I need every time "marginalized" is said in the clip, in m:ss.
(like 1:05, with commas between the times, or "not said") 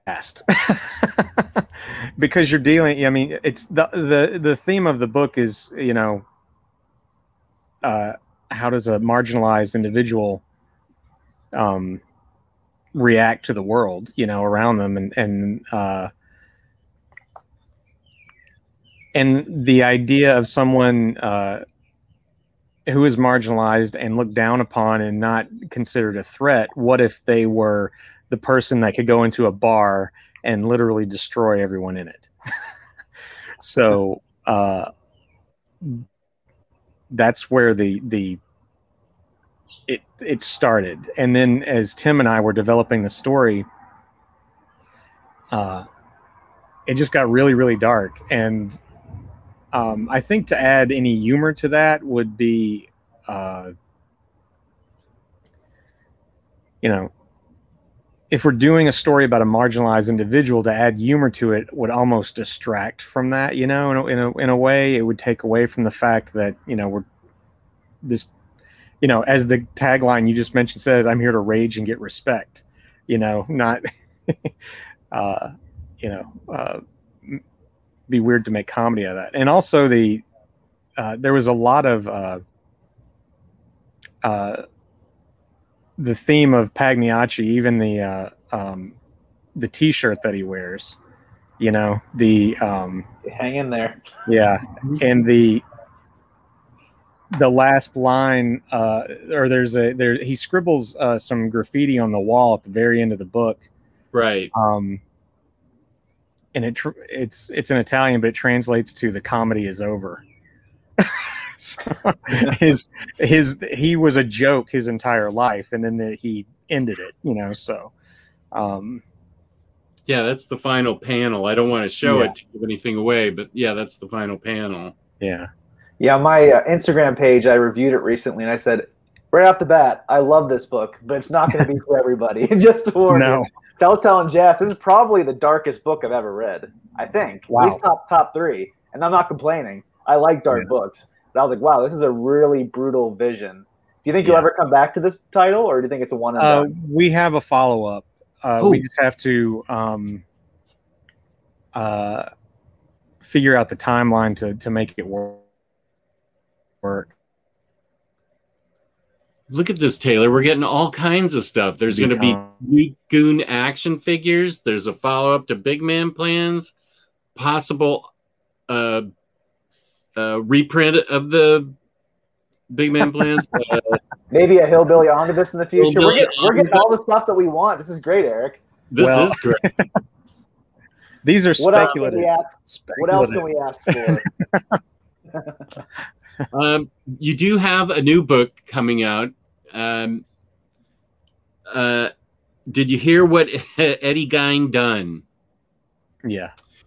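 0:08, 0:23, 0:59.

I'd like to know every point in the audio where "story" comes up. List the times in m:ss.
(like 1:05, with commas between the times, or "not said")
0:43, 0:58.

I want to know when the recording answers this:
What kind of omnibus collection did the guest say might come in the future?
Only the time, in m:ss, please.
2:54.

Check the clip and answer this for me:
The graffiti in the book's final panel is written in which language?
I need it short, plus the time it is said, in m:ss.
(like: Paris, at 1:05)
Italian, at 1:47.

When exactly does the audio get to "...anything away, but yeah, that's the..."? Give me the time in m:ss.
2:02.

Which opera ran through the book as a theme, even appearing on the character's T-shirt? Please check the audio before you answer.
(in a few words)
Pagliacci.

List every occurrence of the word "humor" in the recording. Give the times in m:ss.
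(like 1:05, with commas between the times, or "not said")
0:51, 1:00.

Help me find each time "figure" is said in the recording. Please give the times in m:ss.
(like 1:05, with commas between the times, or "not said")
2:33, 2:43.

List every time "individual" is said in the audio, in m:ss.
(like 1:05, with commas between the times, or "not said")
0:09, 1:00.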